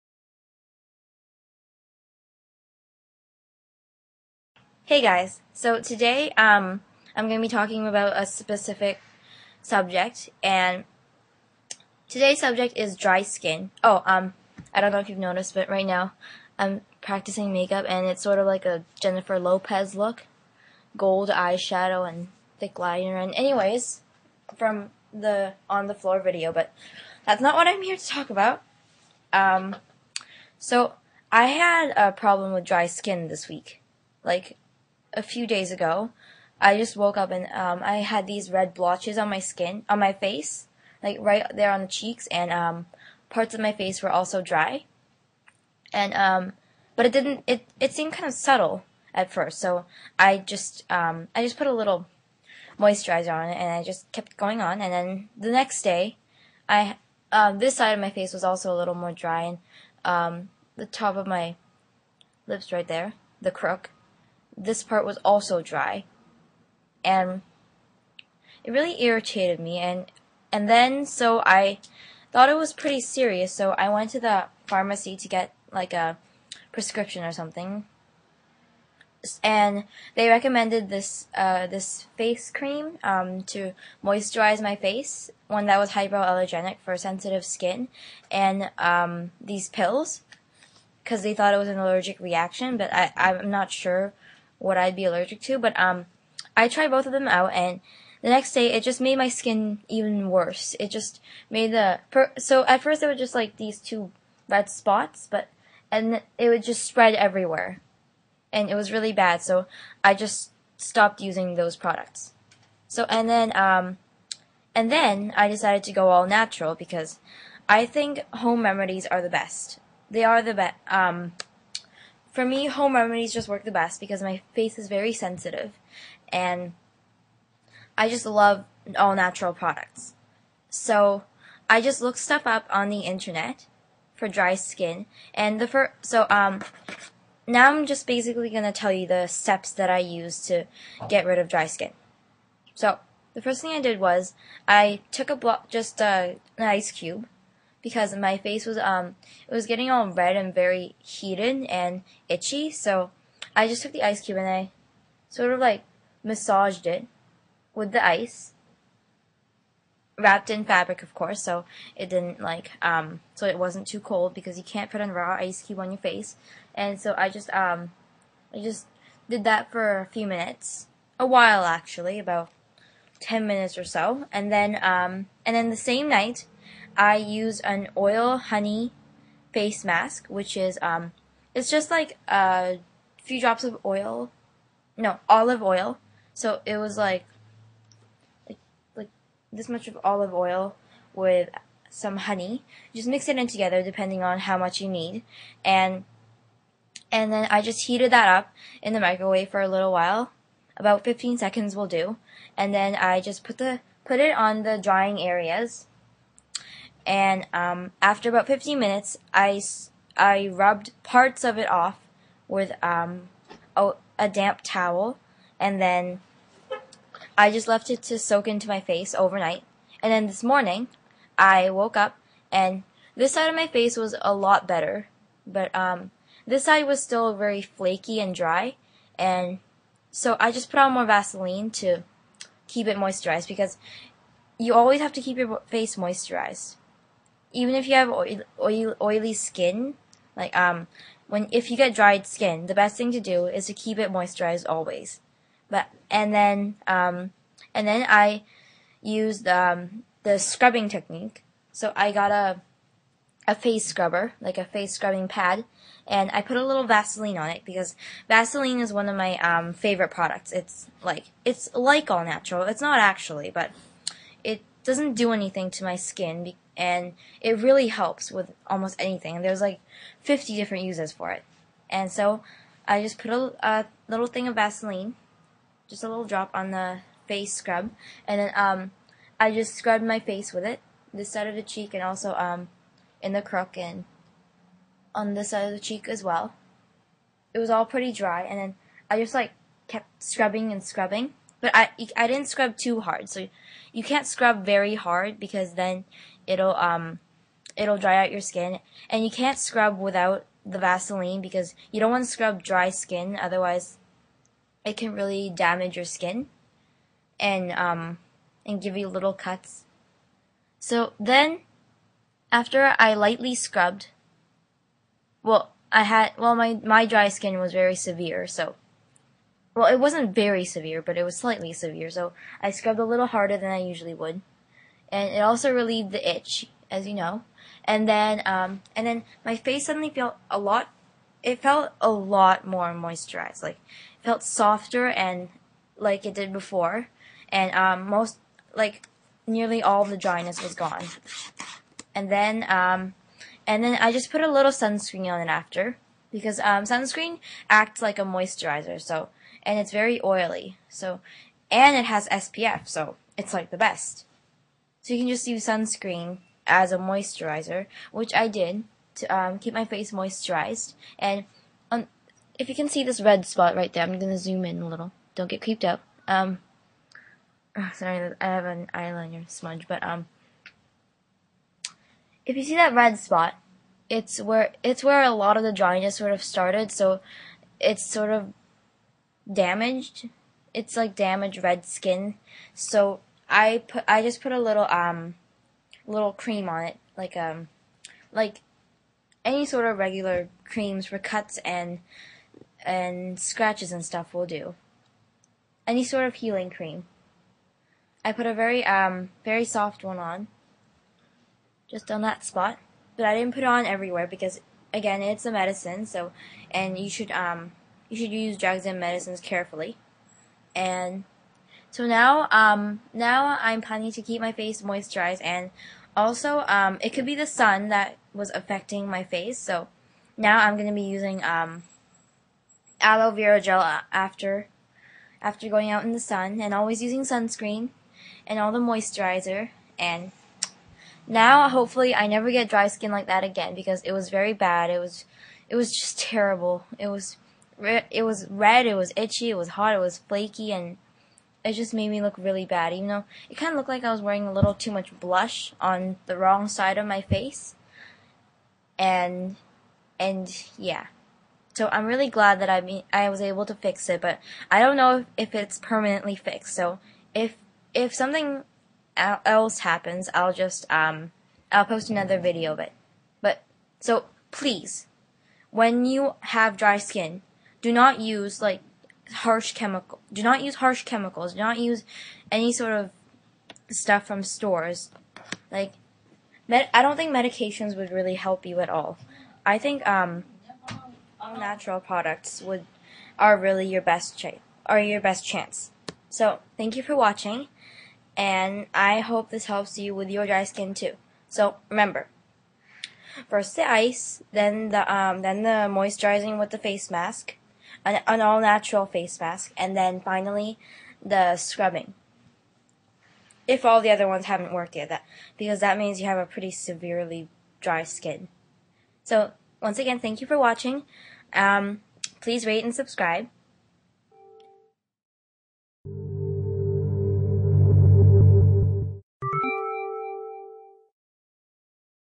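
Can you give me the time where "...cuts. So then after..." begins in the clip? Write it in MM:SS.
05:09.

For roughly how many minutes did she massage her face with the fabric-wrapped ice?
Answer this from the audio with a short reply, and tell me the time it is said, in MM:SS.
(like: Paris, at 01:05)
10, at 02:52.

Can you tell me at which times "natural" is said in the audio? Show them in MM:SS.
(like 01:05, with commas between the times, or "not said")
01:56, 02:09, 04:22, 08:01, 08:18.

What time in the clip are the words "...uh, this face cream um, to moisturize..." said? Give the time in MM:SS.
01:21.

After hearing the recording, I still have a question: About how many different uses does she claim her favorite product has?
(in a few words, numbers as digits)
50.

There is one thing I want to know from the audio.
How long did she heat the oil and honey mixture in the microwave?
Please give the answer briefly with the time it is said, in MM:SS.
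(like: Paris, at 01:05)
15 seconds, at 03:20.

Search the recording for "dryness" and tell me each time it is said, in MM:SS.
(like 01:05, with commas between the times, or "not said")
05:40, 06:15.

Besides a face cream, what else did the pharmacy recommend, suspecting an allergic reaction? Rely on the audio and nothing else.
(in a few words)
pills.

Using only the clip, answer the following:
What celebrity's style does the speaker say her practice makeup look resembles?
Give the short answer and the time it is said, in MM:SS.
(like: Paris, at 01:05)
Jennifer Lopez, at 00:19.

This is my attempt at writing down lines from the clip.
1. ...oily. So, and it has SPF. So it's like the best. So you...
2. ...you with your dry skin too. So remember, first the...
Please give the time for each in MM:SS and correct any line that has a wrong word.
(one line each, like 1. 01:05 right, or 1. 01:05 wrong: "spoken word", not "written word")
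1. 05:50 right
2. 08:09 right.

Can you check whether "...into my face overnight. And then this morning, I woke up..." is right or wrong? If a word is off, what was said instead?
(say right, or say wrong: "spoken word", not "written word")
right.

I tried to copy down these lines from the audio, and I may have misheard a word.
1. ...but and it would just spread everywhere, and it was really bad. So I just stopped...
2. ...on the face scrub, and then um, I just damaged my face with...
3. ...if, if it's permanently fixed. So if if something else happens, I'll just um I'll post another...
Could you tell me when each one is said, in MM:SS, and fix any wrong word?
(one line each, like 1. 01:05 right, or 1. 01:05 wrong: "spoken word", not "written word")
1. 01:45 right
2. 04:36 wrong: "scrubbed", not "damaged"
3. 07:35 right.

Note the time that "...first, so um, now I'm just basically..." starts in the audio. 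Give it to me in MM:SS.
02:15.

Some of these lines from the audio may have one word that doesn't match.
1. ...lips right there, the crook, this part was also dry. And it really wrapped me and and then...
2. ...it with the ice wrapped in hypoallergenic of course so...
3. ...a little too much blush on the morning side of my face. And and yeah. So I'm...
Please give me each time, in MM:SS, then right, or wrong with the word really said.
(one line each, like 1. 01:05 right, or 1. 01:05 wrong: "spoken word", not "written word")
1. 01:02 wrong: "irritated", not "wrapped"
2. 02:36 wrong: "fabric", not "hypoallergenic"
3. 07:24 wrong: "wrong", not "morning".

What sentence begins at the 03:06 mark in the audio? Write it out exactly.
So it was like, like, like this much of olive oil with some honey.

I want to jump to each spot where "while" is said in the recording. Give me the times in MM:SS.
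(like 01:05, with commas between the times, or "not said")
02:51, 03:19.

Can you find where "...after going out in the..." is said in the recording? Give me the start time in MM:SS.
07:05.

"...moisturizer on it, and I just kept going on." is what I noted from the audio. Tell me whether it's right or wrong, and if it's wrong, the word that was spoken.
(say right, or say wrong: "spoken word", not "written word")
right.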